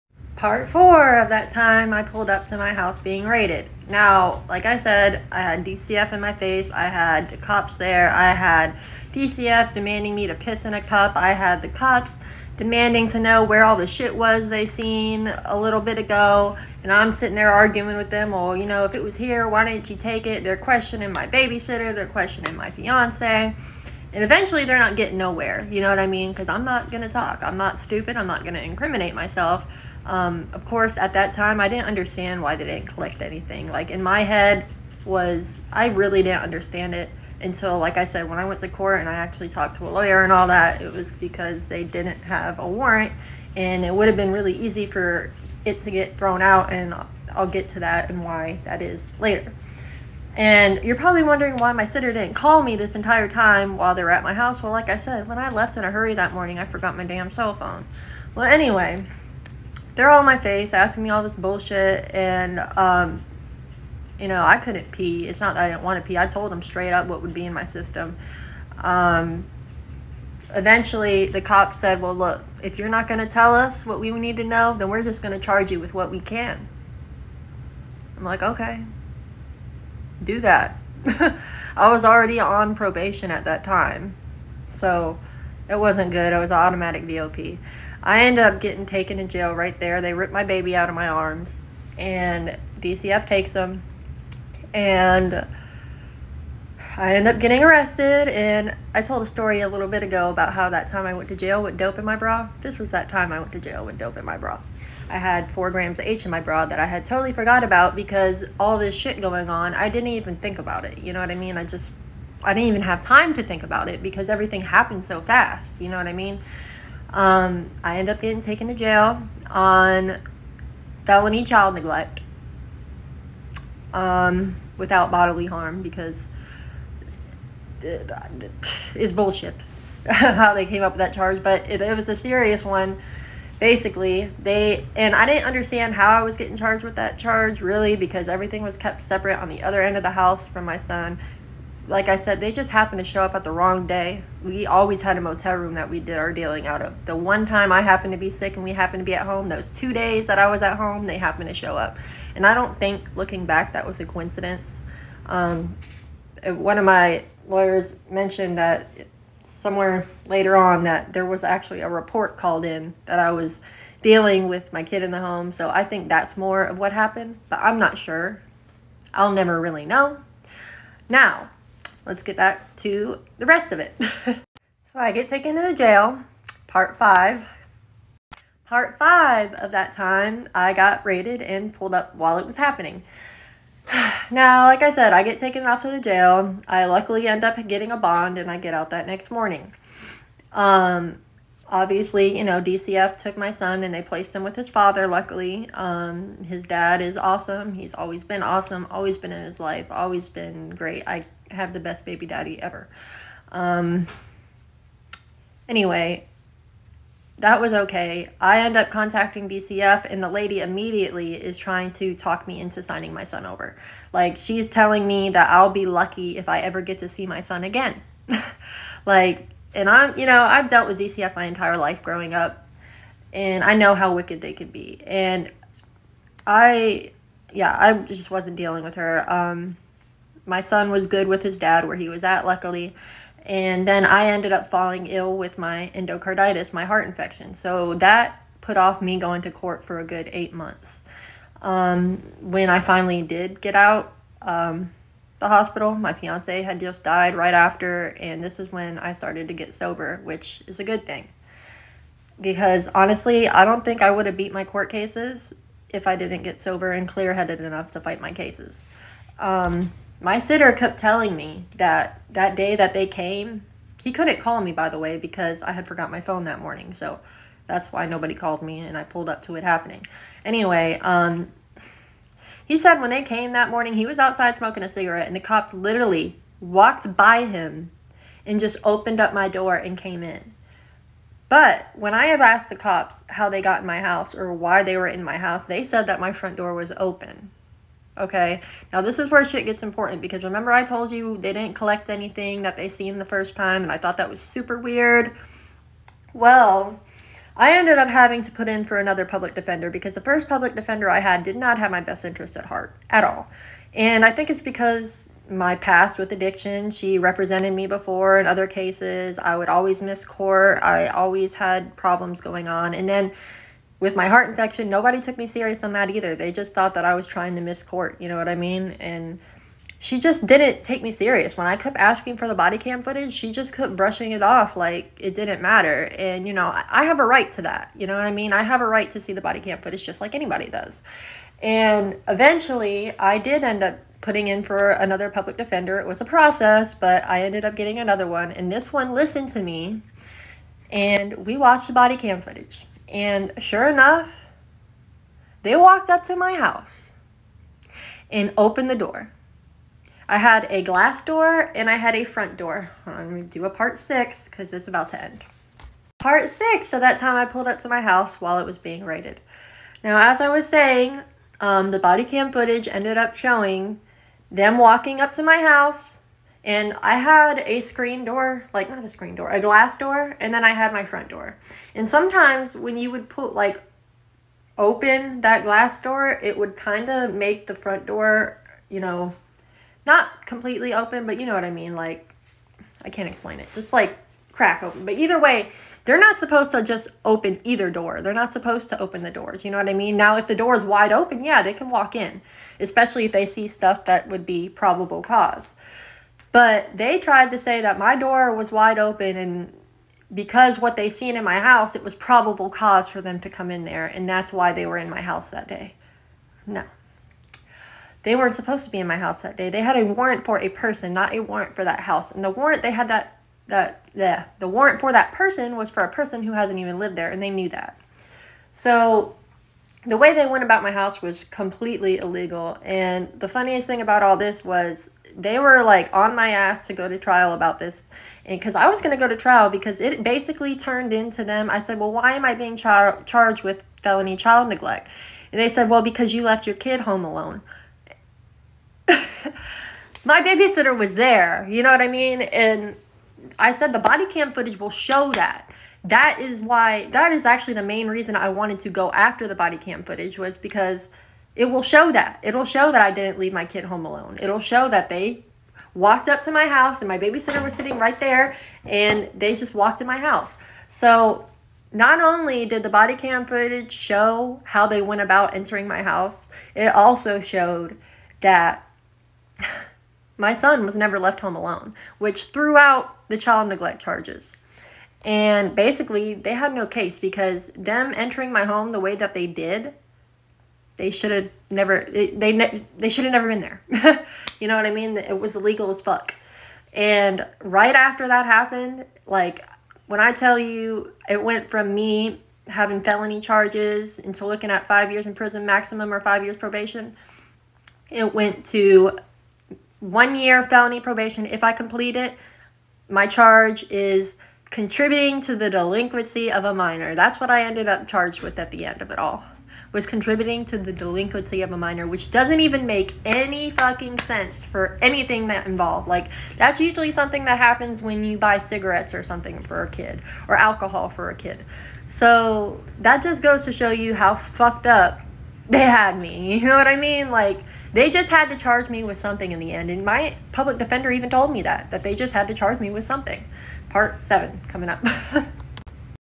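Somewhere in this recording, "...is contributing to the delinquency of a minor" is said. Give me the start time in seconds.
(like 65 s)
503 s.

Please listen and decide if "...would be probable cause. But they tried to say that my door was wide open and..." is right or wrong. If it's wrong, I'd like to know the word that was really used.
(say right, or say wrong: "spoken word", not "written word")
right.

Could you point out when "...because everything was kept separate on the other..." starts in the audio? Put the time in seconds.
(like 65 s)
137 s.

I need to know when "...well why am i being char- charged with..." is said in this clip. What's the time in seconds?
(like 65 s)
431 s.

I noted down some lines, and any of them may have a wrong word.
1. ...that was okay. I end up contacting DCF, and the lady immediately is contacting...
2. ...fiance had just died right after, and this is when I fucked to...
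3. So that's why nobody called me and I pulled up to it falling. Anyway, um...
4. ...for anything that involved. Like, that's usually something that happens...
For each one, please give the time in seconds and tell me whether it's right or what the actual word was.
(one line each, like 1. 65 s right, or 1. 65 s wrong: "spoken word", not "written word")
1. 207 s wrong: "trying", not "contacting"
2. 246 s wrong: "started", not "fucked"
3. 266 s wrong: "happening", not "falling"
4. 514 s right.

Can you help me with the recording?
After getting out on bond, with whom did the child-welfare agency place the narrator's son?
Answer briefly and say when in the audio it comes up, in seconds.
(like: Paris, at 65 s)
his father, at 194 s.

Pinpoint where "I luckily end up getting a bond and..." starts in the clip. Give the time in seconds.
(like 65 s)
186 s.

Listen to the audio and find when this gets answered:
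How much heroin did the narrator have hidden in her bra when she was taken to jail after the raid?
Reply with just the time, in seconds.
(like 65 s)
105 s.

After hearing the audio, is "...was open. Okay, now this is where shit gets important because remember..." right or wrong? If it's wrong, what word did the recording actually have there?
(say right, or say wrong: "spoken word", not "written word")
right.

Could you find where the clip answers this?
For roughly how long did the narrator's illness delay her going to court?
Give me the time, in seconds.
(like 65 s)
240 s.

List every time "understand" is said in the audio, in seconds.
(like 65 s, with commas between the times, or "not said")
31 s, 36 s, 135 s.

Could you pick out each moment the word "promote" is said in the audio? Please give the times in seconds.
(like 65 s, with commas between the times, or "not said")
not said.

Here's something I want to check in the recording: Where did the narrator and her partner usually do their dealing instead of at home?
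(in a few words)
a motel room.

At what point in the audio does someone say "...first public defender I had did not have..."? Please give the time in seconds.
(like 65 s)
300 s.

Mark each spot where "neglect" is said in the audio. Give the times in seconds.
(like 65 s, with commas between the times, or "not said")
121 s, 434 s, 473 s.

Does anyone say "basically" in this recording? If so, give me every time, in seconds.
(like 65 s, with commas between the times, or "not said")
133 s, 430 s, 475 s.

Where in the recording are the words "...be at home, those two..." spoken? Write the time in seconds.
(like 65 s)
149 s.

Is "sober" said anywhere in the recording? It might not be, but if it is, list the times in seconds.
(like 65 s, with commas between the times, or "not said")
249 s, 256 s.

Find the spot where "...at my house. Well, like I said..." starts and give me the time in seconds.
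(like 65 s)
54 s.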